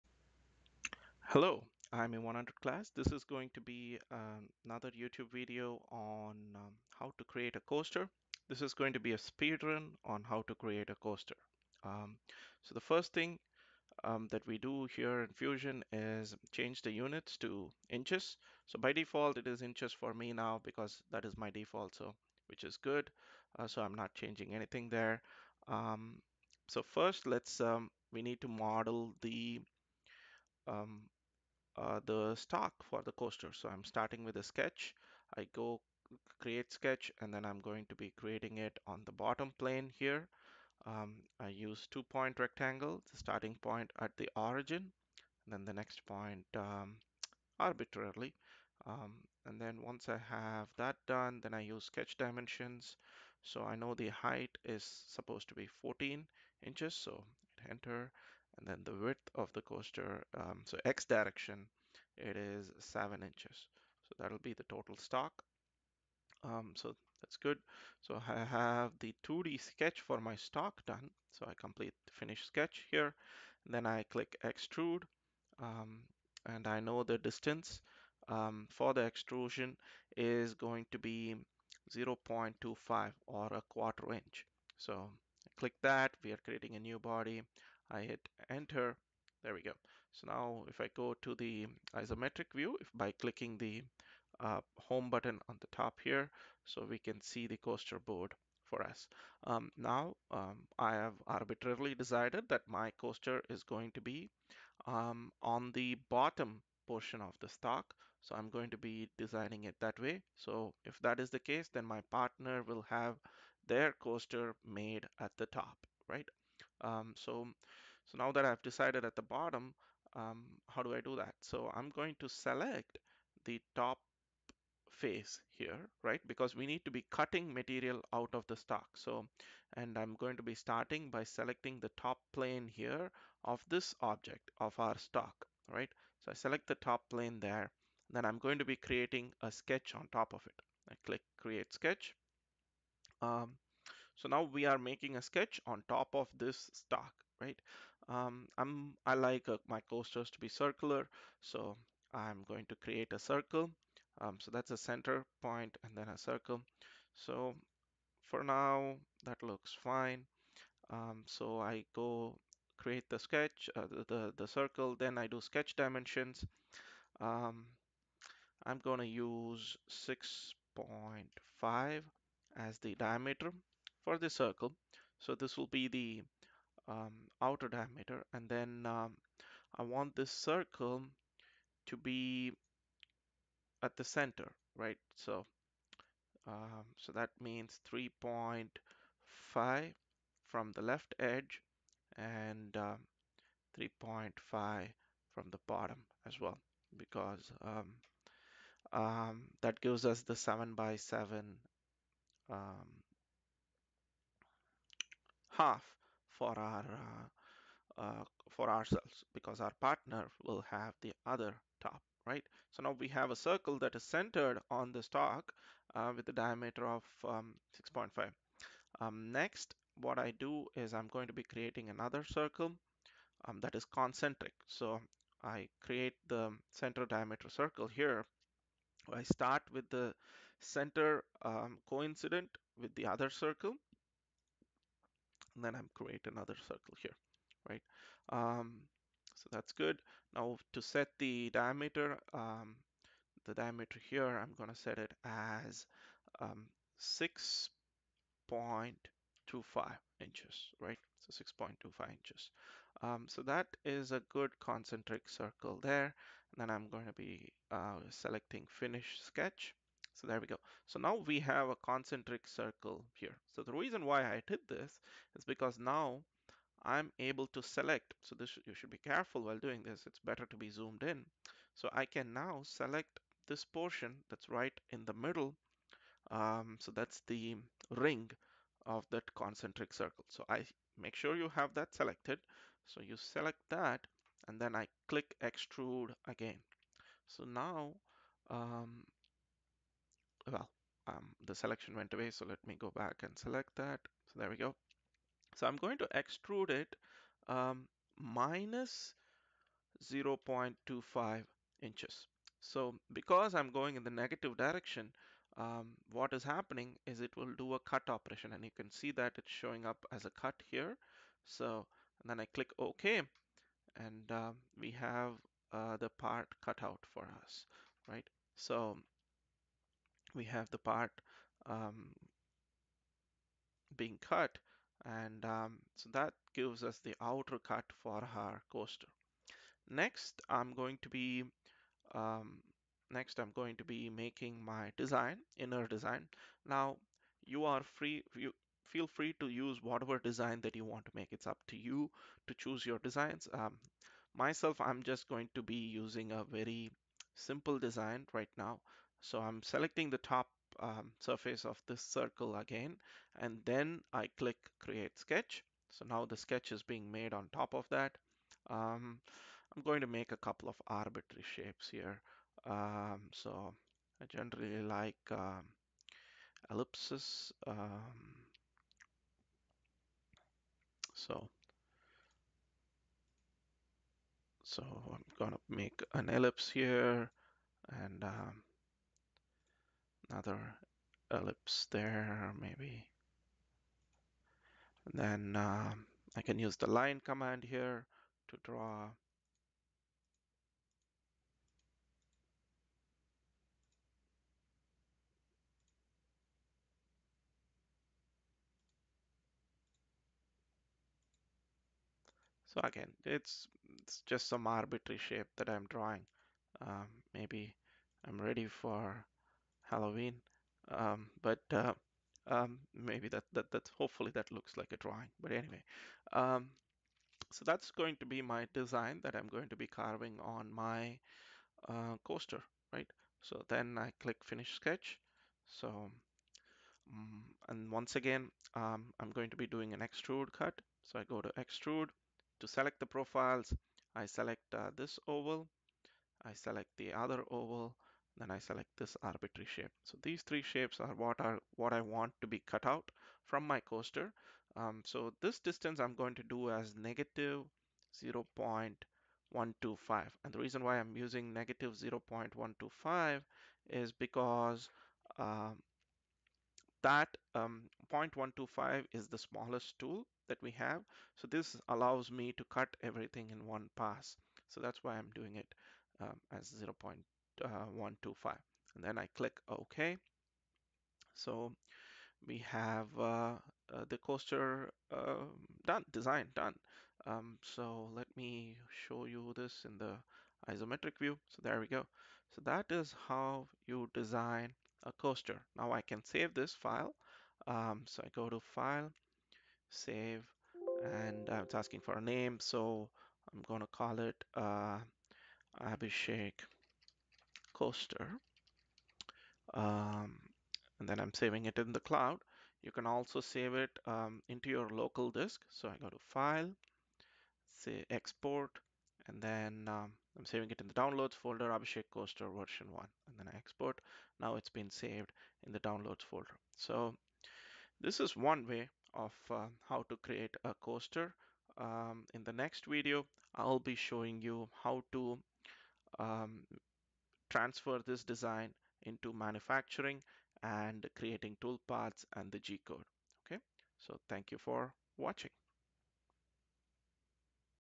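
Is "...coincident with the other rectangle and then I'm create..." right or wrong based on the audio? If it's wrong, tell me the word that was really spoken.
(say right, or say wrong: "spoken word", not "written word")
wrong: "circle", not "rectangle".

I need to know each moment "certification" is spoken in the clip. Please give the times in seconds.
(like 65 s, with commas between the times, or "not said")
not said.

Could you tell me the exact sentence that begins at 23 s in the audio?
Uh, so I'm not changing anything there.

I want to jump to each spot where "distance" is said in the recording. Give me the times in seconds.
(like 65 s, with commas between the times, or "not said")
77 s, 445 s.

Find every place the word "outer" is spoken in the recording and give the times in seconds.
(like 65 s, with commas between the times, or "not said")
177 s, 327 s.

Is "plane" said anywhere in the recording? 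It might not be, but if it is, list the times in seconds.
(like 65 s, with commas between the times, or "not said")
39 s, 132 s, 137 s.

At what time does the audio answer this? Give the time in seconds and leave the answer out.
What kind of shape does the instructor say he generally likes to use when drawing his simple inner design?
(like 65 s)
366 s.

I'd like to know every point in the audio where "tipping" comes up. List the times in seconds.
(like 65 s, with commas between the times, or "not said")
not said.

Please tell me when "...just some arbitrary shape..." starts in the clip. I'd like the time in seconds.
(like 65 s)
404 s.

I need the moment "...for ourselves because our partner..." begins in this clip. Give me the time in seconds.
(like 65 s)
208 s.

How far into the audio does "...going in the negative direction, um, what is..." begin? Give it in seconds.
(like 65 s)
303 s.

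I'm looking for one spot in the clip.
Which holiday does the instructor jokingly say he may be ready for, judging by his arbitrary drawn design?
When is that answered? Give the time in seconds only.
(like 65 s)
409 s.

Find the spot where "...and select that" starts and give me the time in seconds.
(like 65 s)
293 s.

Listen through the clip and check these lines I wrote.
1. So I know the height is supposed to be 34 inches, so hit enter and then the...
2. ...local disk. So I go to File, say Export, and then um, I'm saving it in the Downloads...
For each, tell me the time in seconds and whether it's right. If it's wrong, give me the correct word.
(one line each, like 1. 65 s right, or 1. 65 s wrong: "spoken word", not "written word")
1. 53 s wrong: "14", not "34"
2. 504 s right.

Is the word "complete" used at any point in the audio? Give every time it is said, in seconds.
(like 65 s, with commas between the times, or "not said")
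71 s.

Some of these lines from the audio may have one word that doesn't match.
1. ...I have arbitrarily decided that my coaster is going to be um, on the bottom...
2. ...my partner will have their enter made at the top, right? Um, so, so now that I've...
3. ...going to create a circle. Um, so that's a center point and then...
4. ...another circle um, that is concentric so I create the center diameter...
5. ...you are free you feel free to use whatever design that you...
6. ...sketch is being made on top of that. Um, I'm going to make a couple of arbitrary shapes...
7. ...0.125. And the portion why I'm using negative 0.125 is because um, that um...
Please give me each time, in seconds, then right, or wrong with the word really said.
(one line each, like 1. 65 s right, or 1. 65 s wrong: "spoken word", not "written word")
1. 100 s right
2. 111 s wrong: "coaster", not "enter"
3. 152 s right
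4. 221 s right
5. 337 s right
6. 356 s right
7. 448 s wrong: "reason", not "portion".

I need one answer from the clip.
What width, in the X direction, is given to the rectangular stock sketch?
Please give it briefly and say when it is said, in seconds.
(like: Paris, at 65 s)
7 inches, at 62 s.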